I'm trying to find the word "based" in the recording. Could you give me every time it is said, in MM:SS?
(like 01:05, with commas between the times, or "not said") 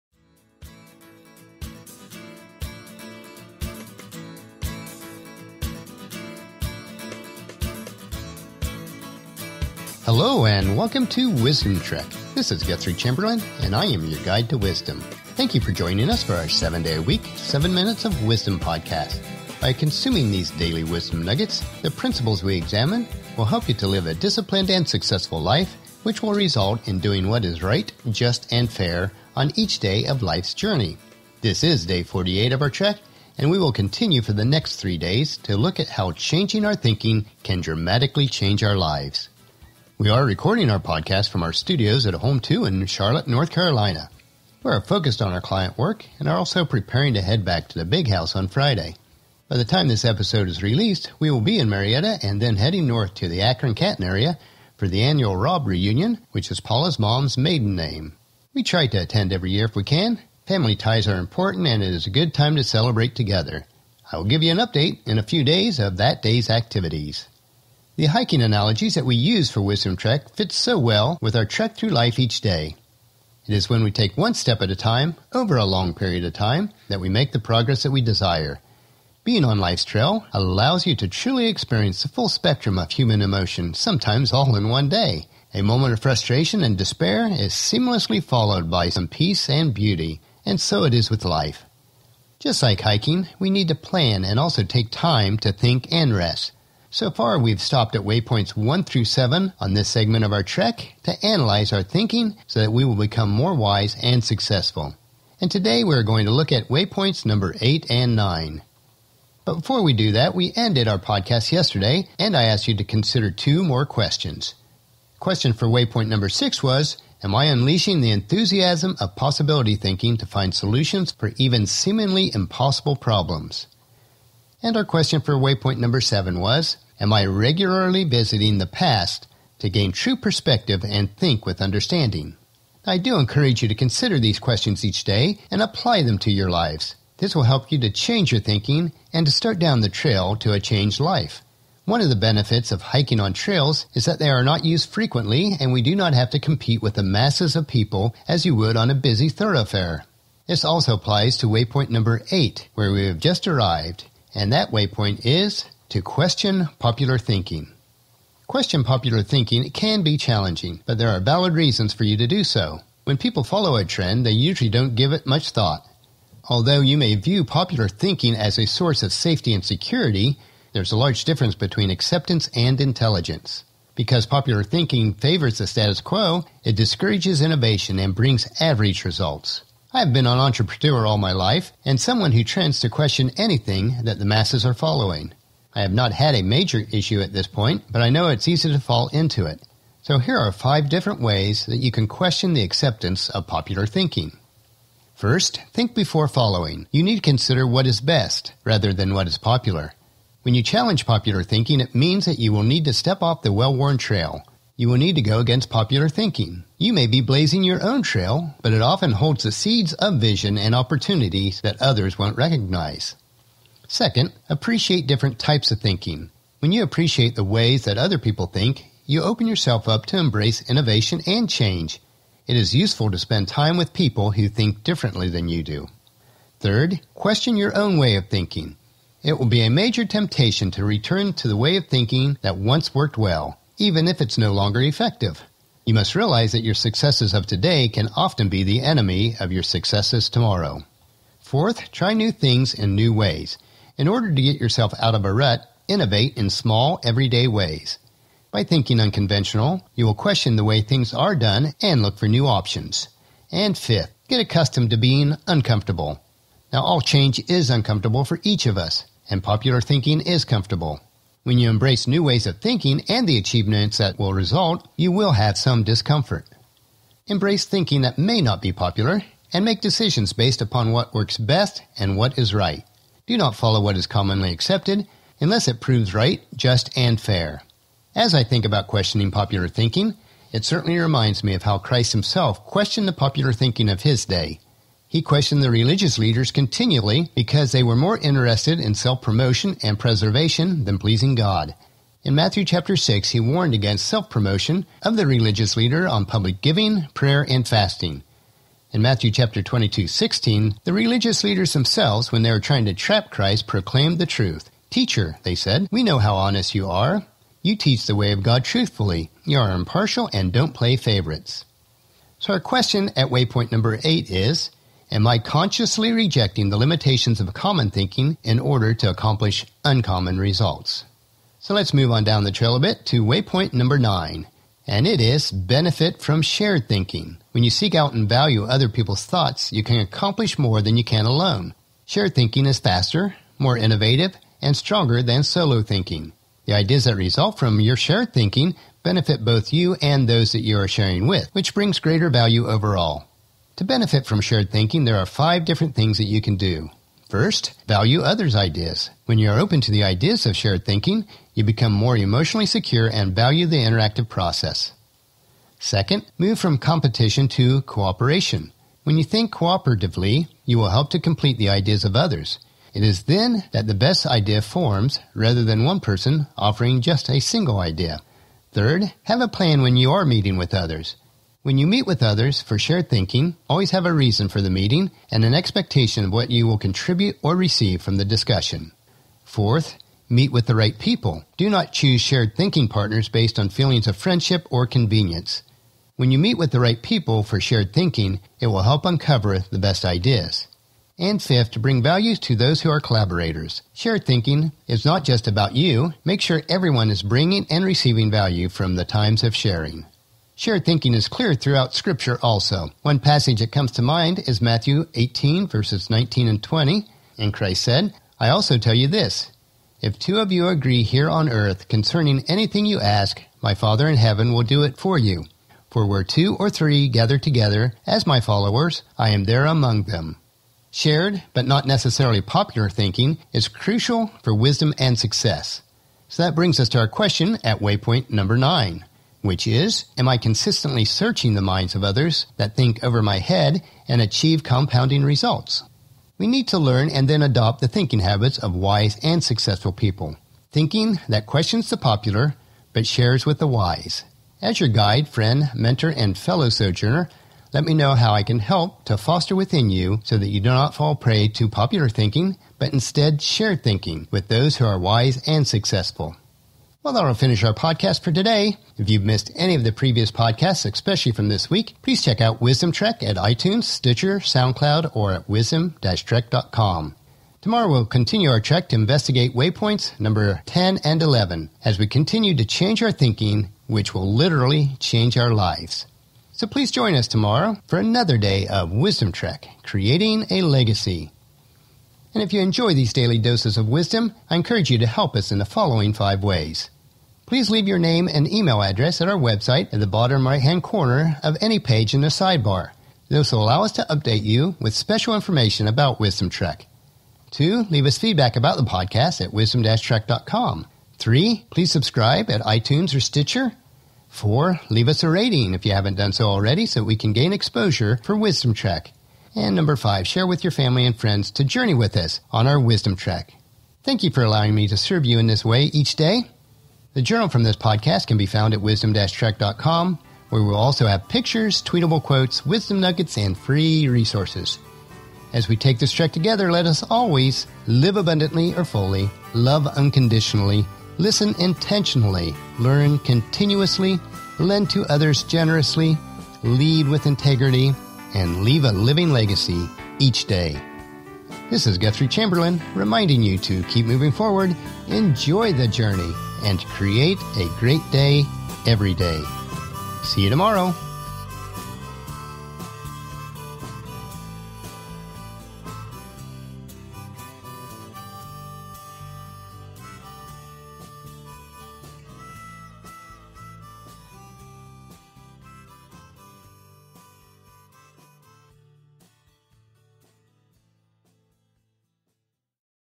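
04:30, 06:23.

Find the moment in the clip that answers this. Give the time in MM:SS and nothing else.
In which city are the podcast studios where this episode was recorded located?
00:42.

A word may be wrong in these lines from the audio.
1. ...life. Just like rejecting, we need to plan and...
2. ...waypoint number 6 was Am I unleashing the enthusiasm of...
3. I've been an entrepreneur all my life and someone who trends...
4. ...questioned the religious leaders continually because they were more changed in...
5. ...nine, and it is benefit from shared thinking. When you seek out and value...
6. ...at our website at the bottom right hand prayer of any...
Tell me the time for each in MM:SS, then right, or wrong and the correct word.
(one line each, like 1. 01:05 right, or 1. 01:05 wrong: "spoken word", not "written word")
1. 01:31 wrong: "hiking", not "rejecting"
2. 01:55 right
3. 02:59 right
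4. 04:45 wrong: "interested", not "changed"
5. 05:23 right
6. 08:09 wrong: "corner", not "prayer".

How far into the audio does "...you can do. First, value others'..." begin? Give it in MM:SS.
05:46.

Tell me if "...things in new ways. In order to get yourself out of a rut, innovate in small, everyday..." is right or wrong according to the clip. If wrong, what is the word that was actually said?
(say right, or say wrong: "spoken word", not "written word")
right.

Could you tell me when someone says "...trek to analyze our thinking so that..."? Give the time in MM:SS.
01:40.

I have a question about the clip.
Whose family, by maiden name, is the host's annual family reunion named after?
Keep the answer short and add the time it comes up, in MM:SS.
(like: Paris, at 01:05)
Rob, at 00:55.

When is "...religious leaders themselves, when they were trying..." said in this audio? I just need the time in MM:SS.
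05:00.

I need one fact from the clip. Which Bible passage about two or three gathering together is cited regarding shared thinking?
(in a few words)
Matthew 18:19-20.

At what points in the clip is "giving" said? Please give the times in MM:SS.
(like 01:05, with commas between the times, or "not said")
04:56.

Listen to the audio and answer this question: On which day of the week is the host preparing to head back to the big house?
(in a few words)
Friday.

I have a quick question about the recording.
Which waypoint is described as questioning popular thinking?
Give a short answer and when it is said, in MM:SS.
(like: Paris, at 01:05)
8, at 02:31.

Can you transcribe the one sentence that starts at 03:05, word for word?
I have not had a major issue at this point, but I know it's easy to fall into it.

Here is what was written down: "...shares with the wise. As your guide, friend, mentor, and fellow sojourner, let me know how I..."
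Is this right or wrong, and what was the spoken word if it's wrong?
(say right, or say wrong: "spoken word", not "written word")
right.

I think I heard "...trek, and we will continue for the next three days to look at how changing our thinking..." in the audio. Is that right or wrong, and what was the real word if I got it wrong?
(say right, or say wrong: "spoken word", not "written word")
right.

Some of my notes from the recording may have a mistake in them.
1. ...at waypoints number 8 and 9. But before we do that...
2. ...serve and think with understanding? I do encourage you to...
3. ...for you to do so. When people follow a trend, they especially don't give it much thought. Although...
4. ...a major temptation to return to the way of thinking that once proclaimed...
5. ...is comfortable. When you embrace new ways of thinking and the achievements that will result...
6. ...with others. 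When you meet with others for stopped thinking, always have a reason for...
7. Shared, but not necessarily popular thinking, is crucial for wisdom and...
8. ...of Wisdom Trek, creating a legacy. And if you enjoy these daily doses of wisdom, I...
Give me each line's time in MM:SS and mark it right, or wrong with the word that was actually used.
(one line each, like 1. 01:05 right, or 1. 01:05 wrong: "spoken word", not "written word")
1. 01:46 right
2. 02:10 wrong: "perspective", not "serve"
3. 02:41 wrong: "usually", not "especially"
4. 03:49 wrong: "worked", not "proclaimed"
5. 04:20 right
6. 06:10 wrong: "shared", not "stopped"
7. 07:00 right
8. 07:58 right.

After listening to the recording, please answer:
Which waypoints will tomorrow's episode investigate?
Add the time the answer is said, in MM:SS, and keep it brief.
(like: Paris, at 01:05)
10 and 11, at 07:49.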